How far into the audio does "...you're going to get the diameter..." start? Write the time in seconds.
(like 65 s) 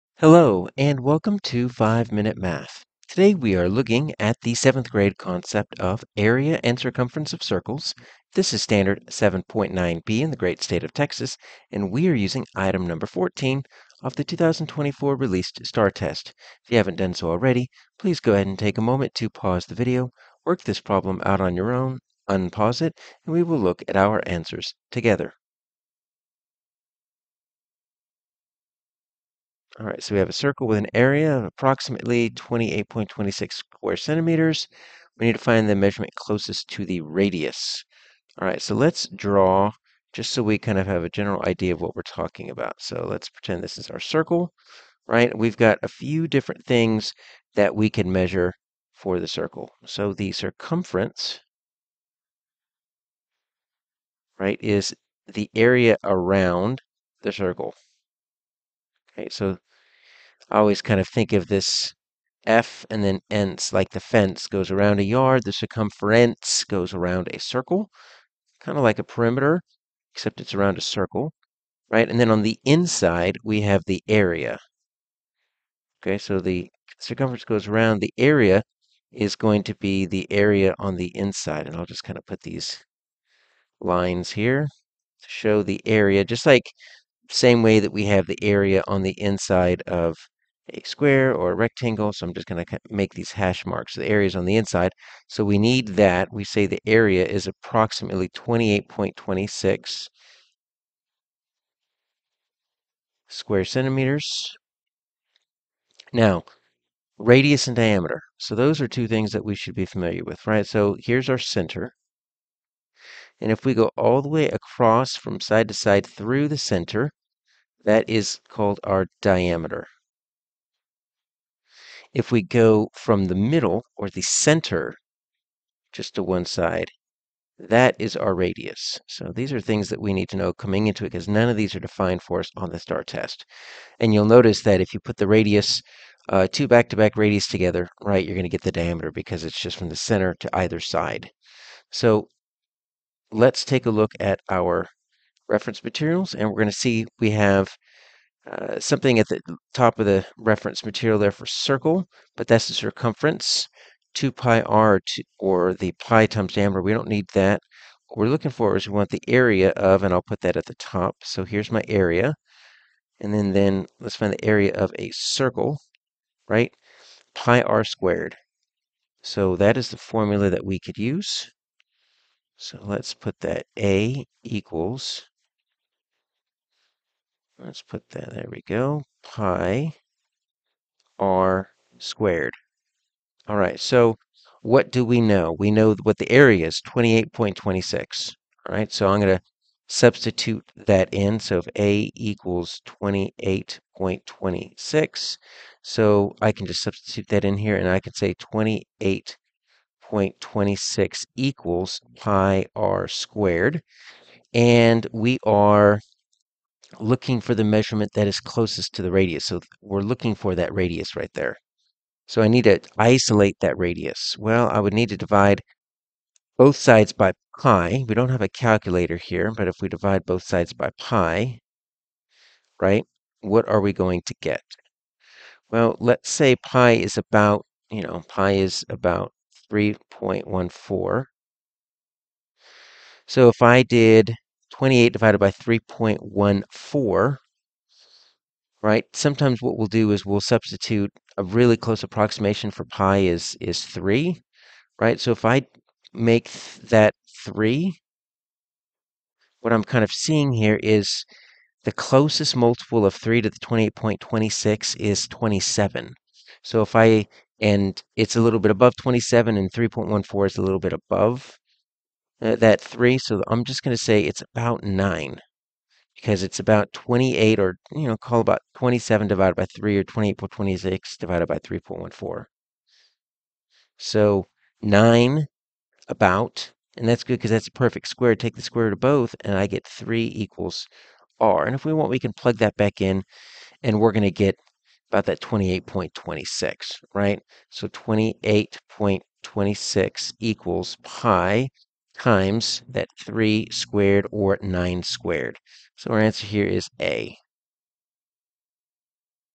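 138 s.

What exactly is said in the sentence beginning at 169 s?
So that is the formula that we could use.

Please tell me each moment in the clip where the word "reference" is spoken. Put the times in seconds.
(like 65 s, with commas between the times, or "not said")
145 s, 150 s.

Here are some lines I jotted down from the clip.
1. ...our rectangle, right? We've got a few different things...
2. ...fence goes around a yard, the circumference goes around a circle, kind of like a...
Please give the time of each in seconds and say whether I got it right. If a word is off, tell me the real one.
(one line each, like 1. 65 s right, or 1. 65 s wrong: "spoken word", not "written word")
1. 43 s wrong: "circle", not "rectangle"
2. 63 s right.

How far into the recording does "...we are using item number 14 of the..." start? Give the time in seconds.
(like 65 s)
11 s.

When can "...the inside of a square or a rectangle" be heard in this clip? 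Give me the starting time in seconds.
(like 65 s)
89 s.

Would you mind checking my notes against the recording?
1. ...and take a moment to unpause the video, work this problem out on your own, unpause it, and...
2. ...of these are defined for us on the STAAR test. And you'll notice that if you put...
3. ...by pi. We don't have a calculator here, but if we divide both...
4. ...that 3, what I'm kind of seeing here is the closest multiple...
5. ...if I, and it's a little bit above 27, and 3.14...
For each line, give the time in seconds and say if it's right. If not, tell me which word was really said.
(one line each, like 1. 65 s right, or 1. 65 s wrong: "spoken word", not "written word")
1. 18 s wrong: "pause", not "unpause"
2. 131 s right
3. 217 s right
4. 246 s right
5. 256 s right.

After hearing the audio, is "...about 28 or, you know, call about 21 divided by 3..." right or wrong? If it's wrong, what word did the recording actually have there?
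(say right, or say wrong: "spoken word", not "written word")
wrong: "27", not "21".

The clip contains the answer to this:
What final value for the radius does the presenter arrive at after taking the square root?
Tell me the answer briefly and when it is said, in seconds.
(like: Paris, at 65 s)
3, at 279 s.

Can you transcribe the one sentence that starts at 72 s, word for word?
And then on the inside, we have the area.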